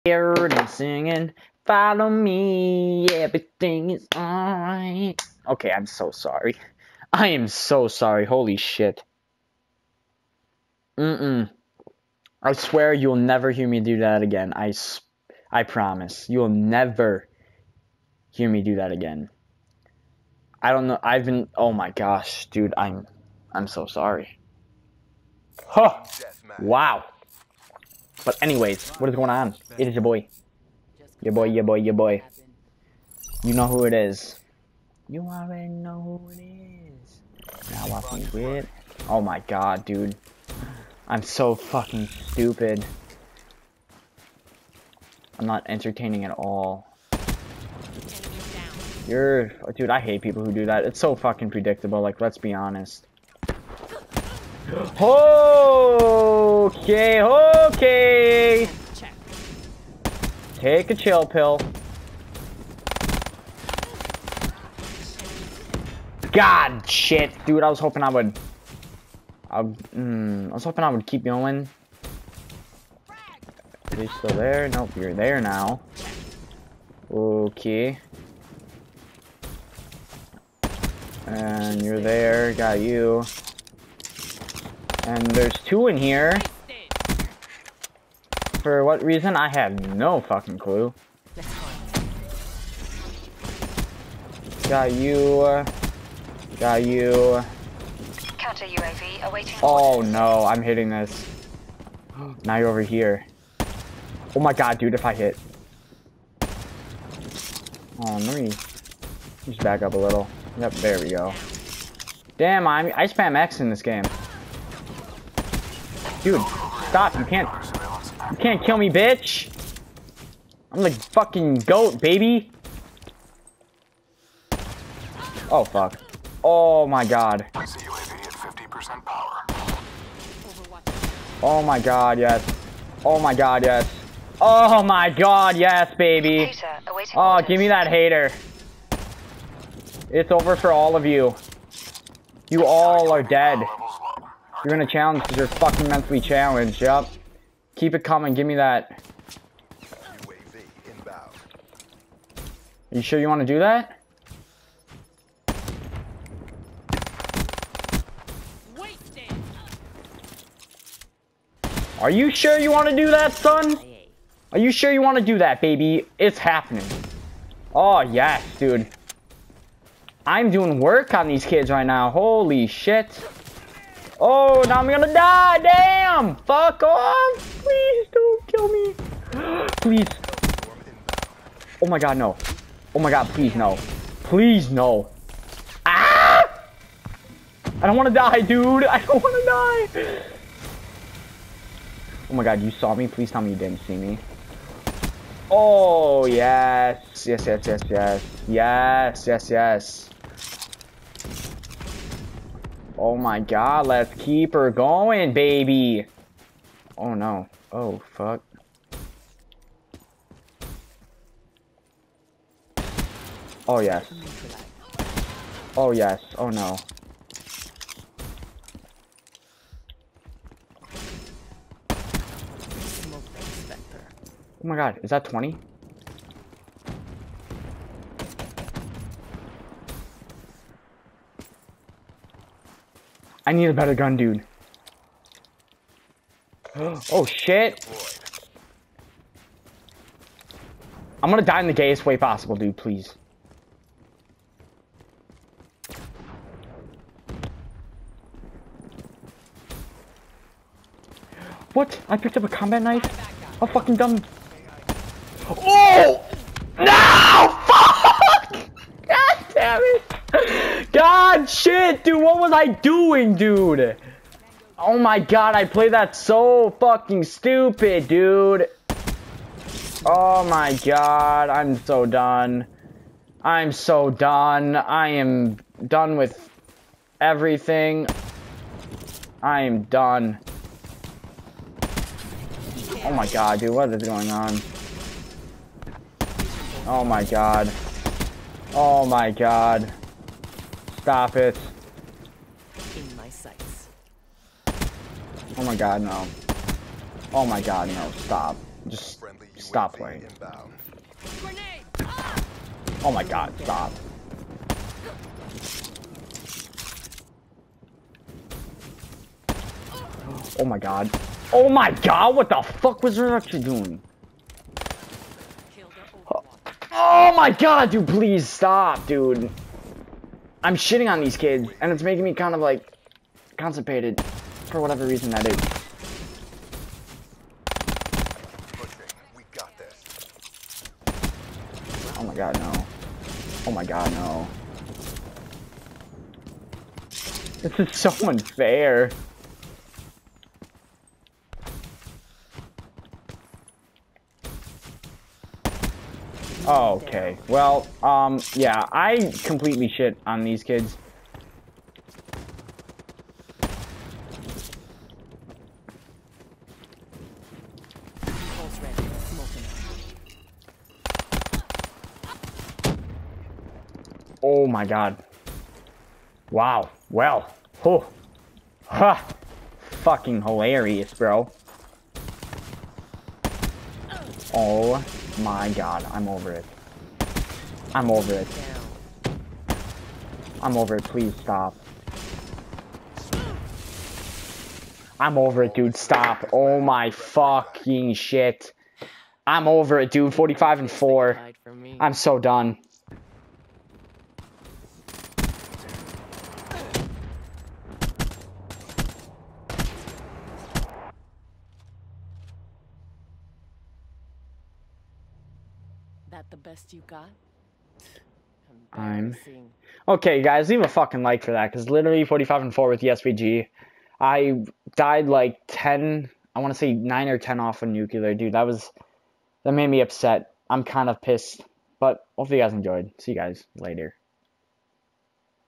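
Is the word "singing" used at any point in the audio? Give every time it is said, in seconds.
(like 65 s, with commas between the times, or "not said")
0 s.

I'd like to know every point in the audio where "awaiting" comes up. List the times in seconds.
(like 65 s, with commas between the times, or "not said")
99 s.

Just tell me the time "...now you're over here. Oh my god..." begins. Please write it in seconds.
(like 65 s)
102 s.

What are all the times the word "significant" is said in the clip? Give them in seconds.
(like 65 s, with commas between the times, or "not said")
not said.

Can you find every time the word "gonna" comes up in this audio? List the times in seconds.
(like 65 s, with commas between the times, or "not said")
174 s, 241 s.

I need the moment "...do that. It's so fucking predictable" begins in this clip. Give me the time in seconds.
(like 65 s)
50 s.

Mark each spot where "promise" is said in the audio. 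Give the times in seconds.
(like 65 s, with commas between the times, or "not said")
15 s.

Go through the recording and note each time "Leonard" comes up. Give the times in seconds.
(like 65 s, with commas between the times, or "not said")
not said.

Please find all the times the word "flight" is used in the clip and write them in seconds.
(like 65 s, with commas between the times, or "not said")
not said.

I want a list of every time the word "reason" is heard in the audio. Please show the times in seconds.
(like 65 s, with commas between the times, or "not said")
89 s, 325 s.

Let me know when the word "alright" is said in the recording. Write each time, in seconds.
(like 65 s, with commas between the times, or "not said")
4 s.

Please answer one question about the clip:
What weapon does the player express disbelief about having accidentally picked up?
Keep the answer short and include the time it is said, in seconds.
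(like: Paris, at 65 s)
combat knife, at 252 s.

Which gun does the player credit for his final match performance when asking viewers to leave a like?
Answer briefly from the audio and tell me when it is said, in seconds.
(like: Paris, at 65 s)
SVG, at 413 s.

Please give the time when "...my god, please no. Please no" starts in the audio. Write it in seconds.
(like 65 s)
182 s.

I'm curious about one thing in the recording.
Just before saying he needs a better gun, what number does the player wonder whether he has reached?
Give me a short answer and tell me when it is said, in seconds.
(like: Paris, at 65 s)
20, at 225 s.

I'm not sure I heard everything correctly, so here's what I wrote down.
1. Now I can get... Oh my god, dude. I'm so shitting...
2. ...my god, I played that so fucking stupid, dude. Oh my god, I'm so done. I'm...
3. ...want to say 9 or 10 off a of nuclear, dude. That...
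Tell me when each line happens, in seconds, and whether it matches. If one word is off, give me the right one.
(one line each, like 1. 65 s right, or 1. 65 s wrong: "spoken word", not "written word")
1. 37 s wrong: "fucking", not "shitting"
2. 264 s right
3. 416 s right.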